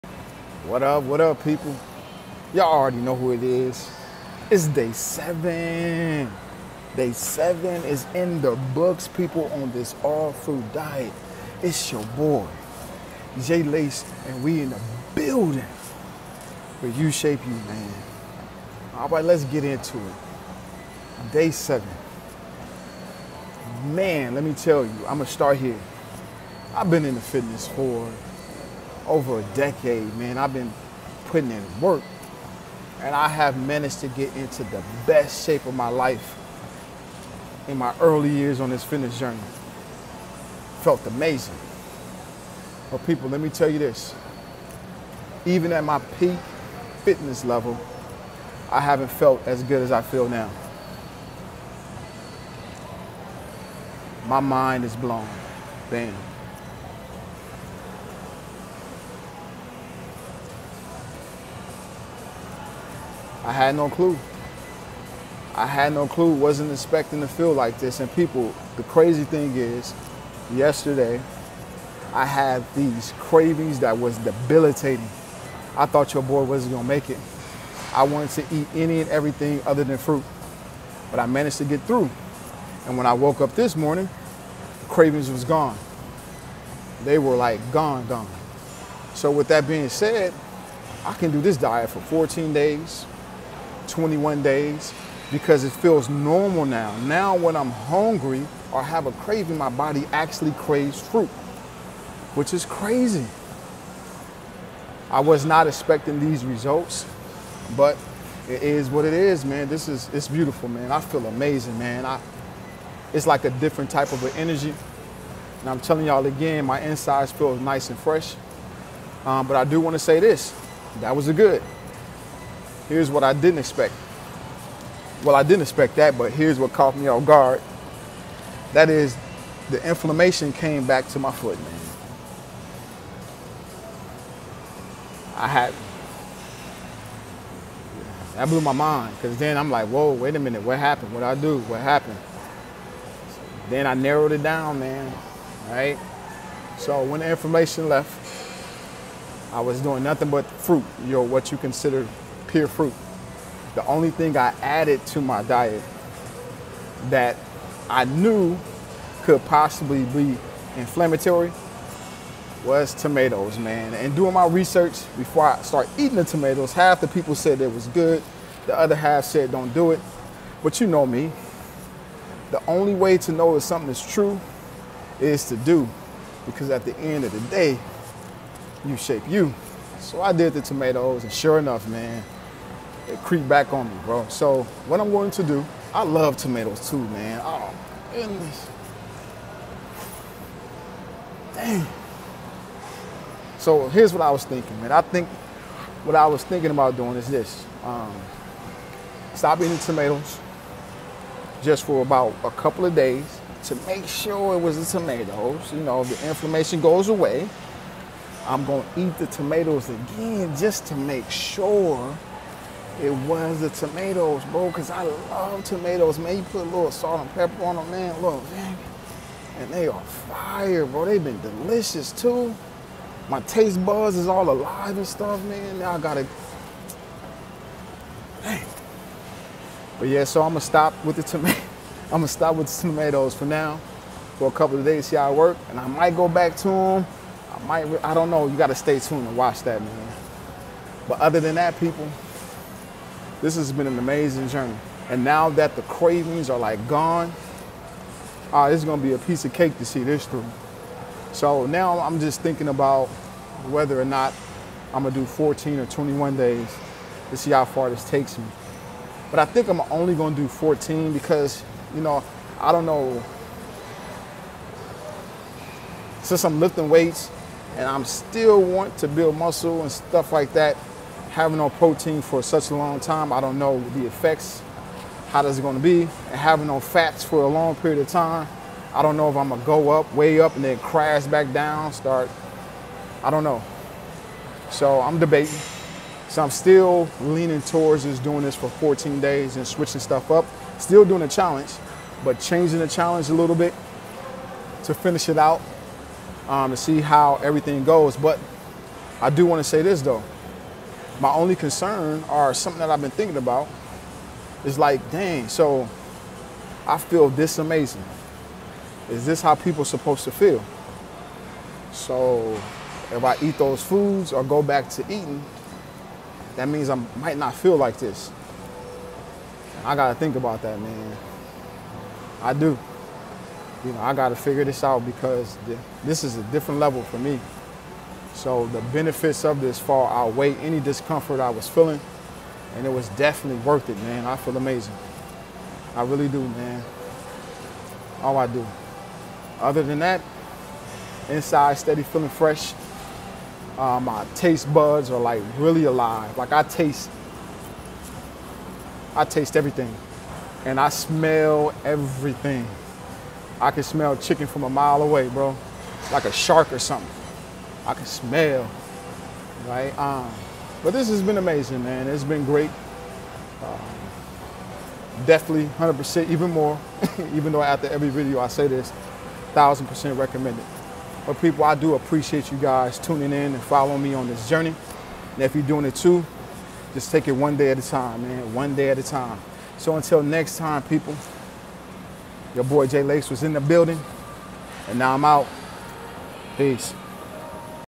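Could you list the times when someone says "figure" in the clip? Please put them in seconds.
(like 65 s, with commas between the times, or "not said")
324 s.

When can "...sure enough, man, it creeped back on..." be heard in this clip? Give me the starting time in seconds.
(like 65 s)
181 s.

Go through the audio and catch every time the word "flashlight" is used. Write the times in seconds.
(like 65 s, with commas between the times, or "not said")
not said.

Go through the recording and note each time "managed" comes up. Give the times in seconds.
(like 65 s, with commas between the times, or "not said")
33 s, 81 s.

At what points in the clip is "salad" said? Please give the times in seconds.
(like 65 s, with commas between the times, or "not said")
not said.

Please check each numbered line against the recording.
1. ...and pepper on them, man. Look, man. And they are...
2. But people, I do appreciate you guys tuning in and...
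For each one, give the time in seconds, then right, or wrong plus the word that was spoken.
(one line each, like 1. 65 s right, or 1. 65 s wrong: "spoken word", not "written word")
1. 217 s right
2. 371 s right.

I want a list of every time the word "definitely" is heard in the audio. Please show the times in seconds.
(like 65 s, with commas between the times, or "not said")
333 s, 365 s.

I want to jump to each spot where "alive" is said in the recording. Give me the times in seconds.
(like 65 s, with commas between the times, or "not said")
224 s, 345 s.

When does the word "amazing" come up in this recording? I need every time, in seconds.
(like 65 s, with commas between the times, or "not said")
41 s, 111 s, 243 s, 307 s, 334 s, 361 s.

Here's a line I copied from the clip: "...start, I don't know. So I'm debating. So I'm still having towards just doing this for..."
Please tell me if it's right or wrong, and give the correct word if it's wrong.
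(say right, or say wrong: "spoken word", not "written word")
wrong: "leaning", not "having".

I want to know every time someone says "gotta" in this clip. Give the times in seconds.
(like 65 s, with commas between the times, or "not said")
319 s, 324 s.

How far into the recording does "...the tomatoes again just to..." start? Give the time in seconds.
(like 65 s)
209 s.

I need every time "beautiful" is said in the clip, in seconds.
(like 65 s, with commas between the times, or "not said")
110 s.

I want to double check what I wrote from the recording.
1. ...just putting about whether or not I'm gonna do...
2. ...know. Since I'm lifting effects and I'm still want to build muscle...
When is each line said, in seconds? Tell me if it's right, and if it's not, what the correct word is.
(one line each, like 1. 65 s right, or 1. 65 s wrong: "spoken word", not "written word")
1. 252 s wrong: "thinking", not "putting"
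2. 262 s wrong: "weights", not "effects".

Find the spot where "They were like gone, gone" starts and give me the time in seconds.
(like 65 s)
87 s.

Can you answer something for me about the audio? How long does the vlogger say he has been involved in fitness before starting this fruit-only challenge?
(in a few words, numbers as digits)
over a decade.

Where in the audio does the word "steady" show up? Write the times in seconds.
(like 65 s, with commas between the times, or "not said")
341 s.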